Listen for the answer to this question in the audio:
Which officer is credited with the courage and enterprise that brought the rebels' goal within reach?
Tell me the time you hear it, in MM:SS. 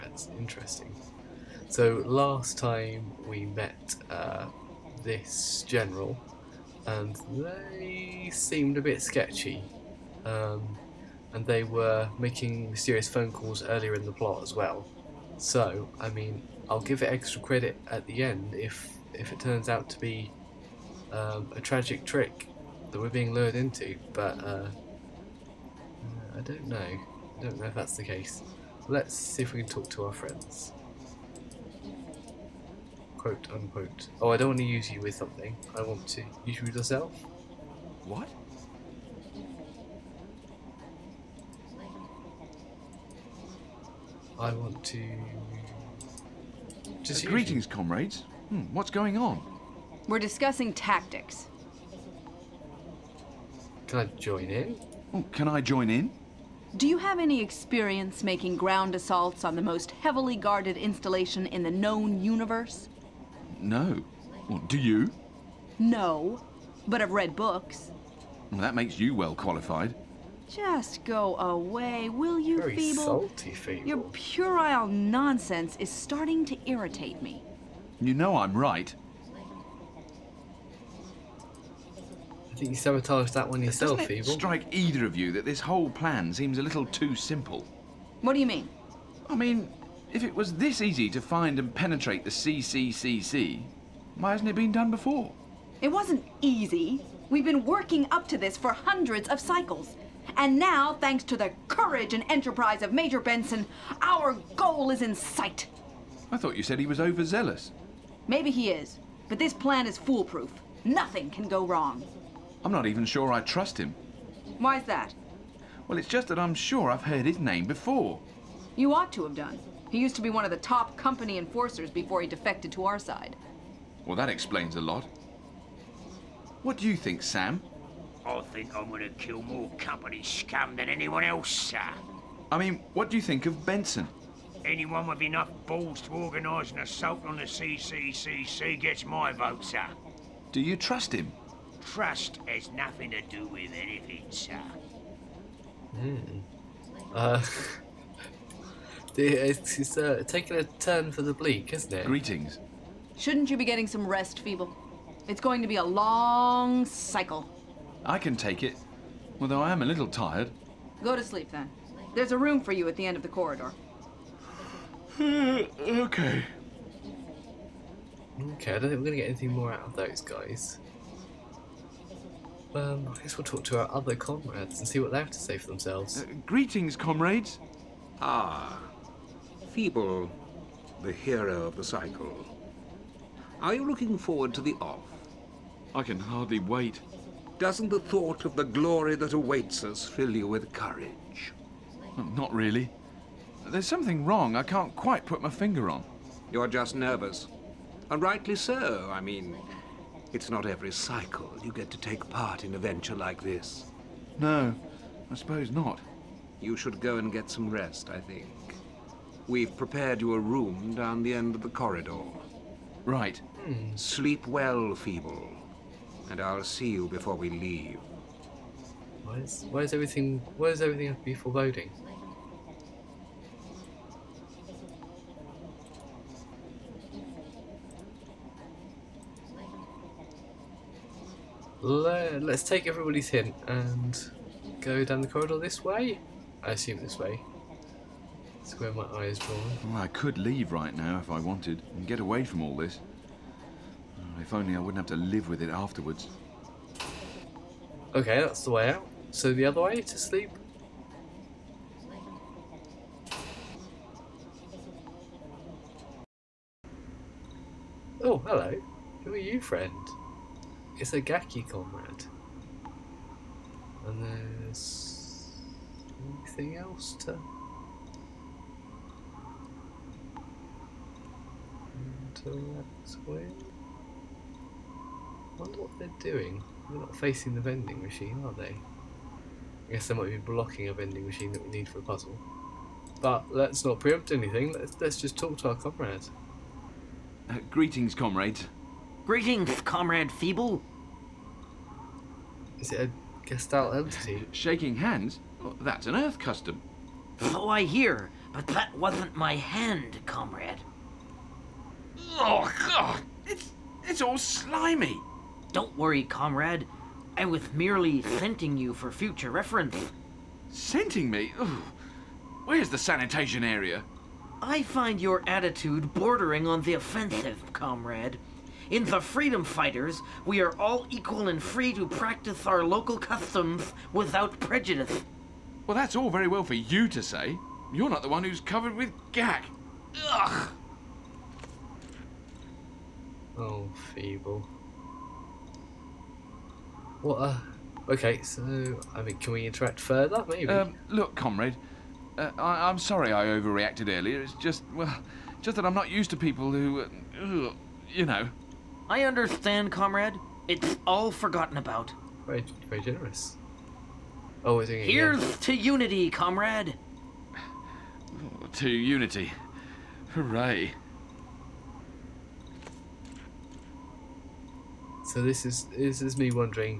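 01:42.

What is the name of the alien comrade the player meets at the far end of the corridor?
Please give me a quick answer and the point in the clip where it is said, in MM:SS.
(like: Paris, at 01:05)
Gaki, at 04:21.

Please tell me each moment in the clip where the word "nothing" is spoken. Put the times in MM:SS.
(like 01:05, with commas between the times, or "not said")
01:50, 02:22.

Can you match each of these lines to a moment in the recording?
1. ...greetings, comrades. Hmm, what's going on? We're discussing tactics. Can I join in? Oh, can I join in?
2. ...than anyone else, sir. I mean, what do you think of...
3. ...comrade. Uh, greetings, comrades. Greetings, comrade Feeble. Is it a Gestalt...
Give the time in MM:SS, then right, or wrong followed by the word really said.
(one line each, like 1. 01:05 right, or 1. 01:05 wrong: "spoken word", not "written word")
1. 00:47 right
2. 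02:10 right
3. 04:45 right.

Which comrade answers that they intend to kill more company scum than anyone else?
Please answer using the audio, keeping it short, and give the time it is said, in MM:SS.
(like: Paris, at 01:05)
Sam, at 02:07.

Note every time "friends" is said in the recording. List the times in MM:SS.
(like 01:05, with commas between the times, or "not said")
00:30, 04:19.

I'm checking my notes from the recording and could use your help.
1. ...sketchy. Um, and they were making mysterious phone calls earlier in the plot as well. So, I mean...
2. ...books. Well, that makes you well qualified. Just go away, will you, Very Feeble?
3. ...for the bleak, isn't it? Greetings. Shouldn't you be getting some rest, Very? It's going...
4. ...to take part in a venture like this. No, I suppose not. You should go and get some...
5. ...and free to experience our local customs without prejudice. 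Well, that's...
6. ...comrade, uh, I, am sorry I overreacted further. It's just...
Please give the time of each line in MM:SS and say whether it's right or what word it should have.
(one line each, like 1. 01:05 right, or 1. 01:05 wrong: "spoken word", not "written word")
1. 00:09 right
2. 01:07 right
3. 02:31 wrong: "Feeble", not "Very"
4. 03:21 right
5. 05:21 wrong: "practice", not "experience"
6. 05:41 wrong: "earlier", not "further".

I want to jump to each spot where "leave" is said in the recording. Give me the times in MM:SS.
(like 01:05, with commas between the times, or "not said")
03:37, 04:00.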